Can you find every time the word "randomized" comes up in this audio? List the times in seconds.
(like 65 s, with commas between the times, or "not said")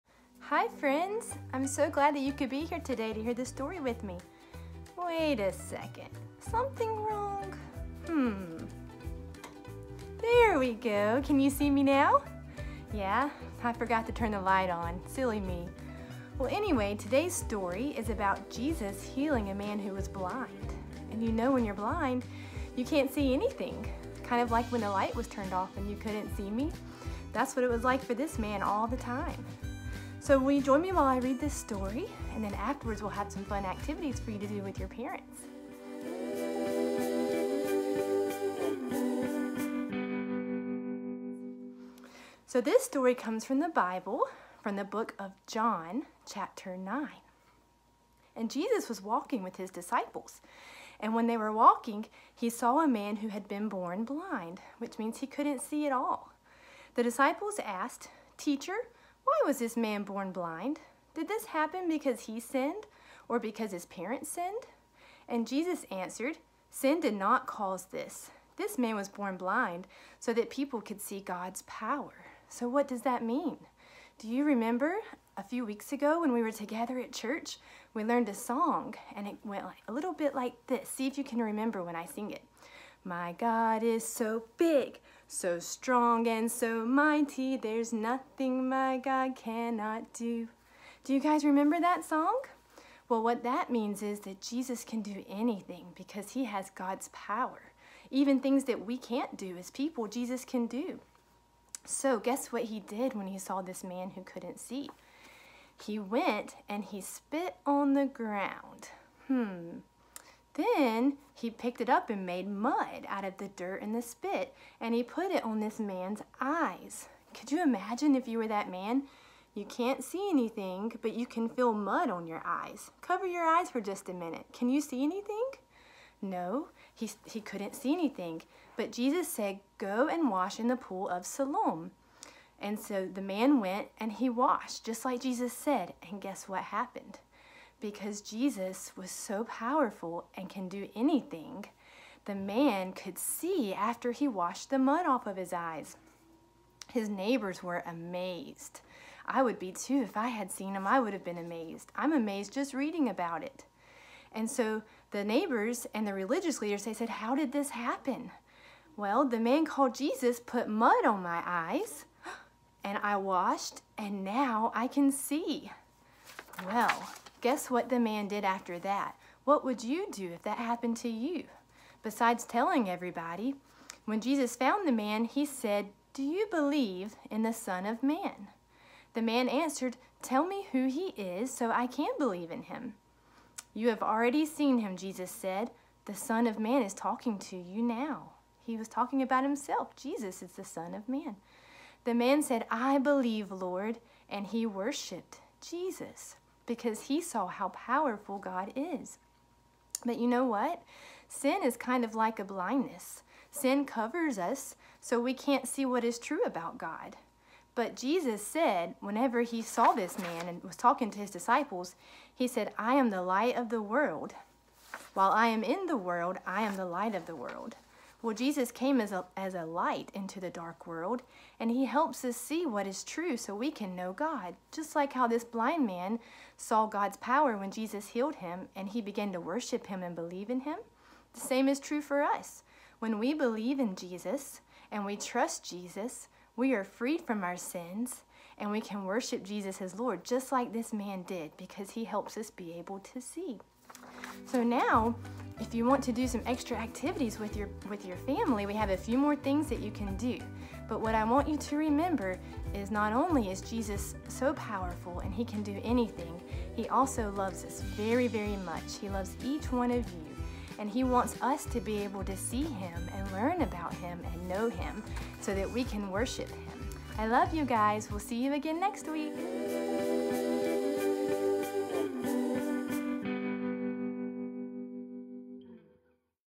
not said.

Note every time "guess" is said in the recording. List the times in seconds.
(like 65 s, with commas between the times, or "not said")
102 s, 136 s, 167 s.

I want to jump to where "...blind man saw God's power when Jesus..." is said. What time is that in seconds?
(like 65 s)
225 s.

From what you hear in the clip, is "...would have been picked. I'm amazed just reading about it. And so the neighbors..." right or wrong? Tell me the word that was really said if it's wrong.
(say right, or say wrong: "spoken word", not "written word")
wrong: "amazed", not "picked".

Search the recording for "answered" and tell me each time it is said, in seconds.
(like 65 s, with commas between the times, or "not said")
65 s, 179 s.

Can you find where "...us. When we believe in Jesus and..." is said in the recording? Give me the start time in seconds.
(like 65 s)
232 s.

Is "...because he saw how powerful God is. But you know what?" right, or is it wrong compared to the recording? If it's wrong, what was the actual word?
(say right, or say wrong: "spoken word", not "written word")
right.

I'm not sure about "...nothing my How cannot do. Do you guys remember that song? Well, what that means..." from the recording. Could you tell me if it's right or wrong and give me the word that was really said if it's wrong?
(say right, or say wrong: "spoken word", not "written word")
wrong: "God", not "How".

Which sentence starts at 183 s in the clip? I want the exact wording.
You have already seen him, Jesus said.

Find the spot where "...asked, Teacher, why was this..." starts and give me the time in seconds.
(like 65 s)
57 s.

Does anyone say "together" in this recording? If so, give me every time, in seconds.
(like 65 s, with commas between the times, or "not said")
76 s.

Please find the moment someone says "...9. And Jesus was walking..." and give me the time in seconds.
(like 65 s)
46 s.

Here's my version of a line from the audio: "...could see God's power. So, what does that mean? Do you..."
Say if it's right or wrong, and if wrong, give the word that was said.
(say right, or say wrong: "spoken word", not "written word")
right.